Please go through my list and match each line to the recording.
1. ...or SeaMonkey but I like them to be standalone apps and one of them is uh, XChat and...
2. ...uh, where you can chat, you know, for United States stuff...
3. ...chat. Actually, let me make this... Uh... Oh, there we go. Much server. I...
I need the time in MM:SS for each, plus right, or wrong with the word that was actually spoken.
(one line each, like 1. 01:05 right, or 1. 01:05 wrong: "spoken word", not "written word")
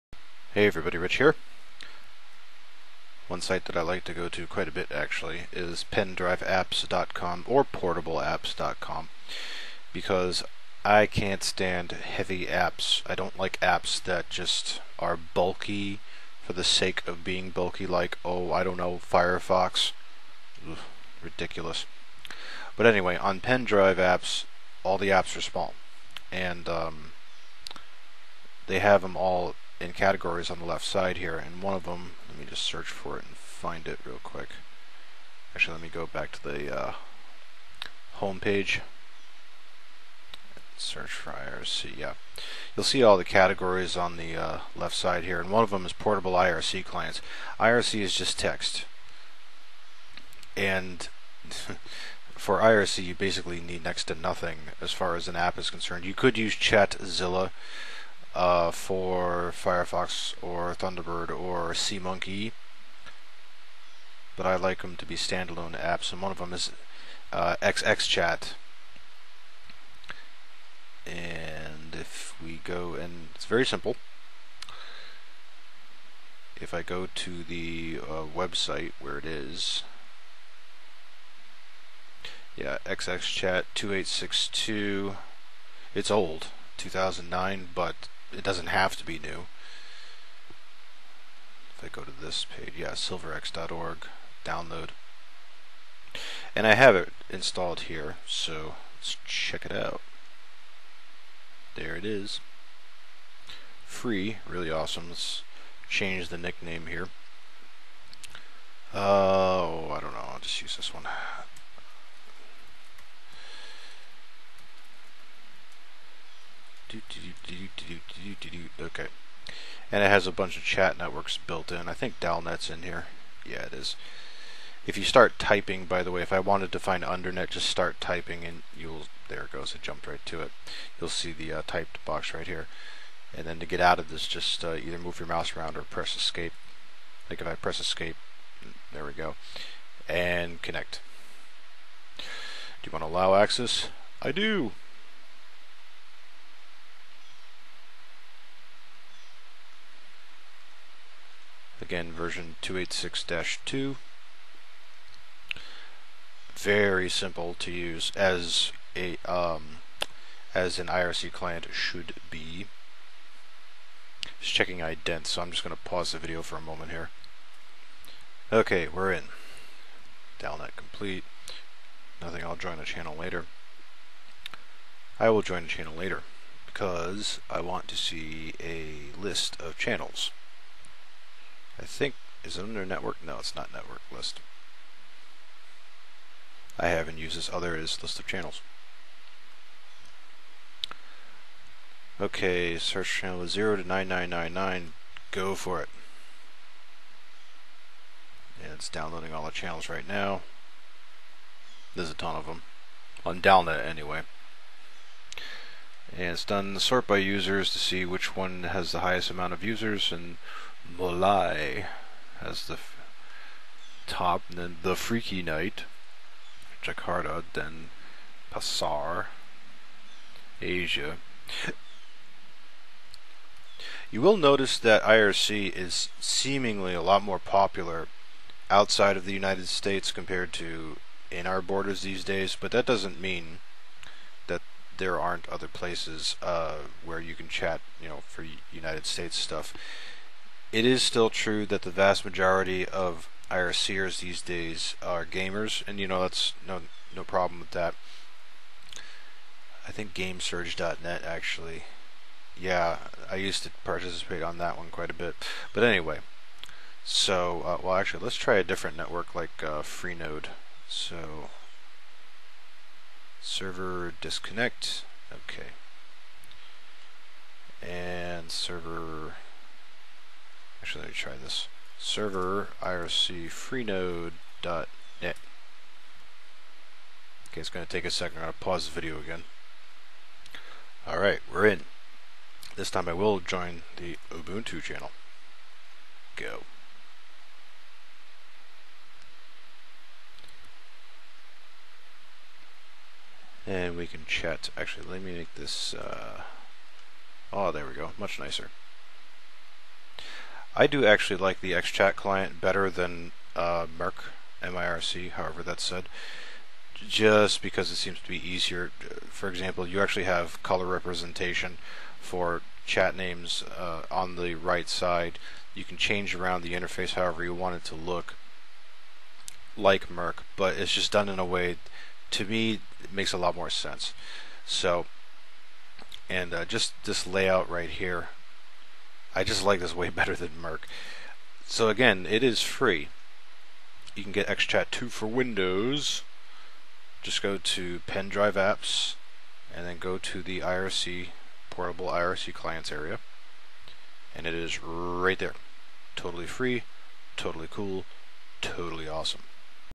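1. 01:01 right
2. 03:56 right
3. 04:54 wrong: "nicer", not "server".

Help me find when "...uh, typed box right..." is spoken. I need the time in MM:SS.
02:11.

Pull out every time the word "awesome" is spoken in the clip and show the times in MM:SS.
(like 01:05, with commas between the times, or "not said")
01:44, 05:49.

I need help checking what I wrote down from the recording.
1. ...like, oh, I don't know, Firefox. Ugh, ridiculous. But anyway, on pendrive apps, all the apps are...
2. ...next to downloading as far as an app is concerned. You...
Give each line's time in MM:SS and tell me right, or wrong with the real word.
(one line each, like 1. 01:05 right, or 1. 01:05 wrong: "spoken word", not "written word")
1. 00:17 right
2. 00:53 wrong: "nothing", not "downloading".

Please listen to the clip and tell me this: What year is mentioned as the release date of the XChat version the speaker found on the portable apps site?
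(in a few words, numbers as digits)
2009.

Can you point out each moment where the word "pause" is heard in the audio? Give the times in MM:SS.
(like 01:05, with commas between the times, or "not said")
02:45, 04:38.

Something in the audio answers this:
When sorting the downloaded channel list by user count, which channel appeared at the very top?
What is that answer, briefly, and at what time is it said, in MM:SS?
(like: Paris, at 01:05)
Molai, at 03:30.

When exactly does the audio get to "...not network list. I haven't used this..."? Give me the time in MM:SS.
03:03.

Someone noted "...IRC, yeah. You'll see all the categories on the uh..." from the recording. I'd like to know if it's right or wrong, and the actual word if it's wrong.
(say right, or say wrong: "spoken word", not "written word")
right.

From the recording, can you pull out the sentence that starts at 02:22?
Do you want to allow access?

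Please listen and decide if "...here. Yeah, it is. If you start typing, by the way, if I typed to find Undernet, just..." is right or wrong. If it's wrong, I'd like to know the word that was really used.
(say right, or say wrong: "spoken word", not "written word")
wrong: "wanted", not "typed".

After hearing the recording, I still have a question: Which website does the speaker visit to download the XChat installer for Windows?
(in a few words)
silverex.org.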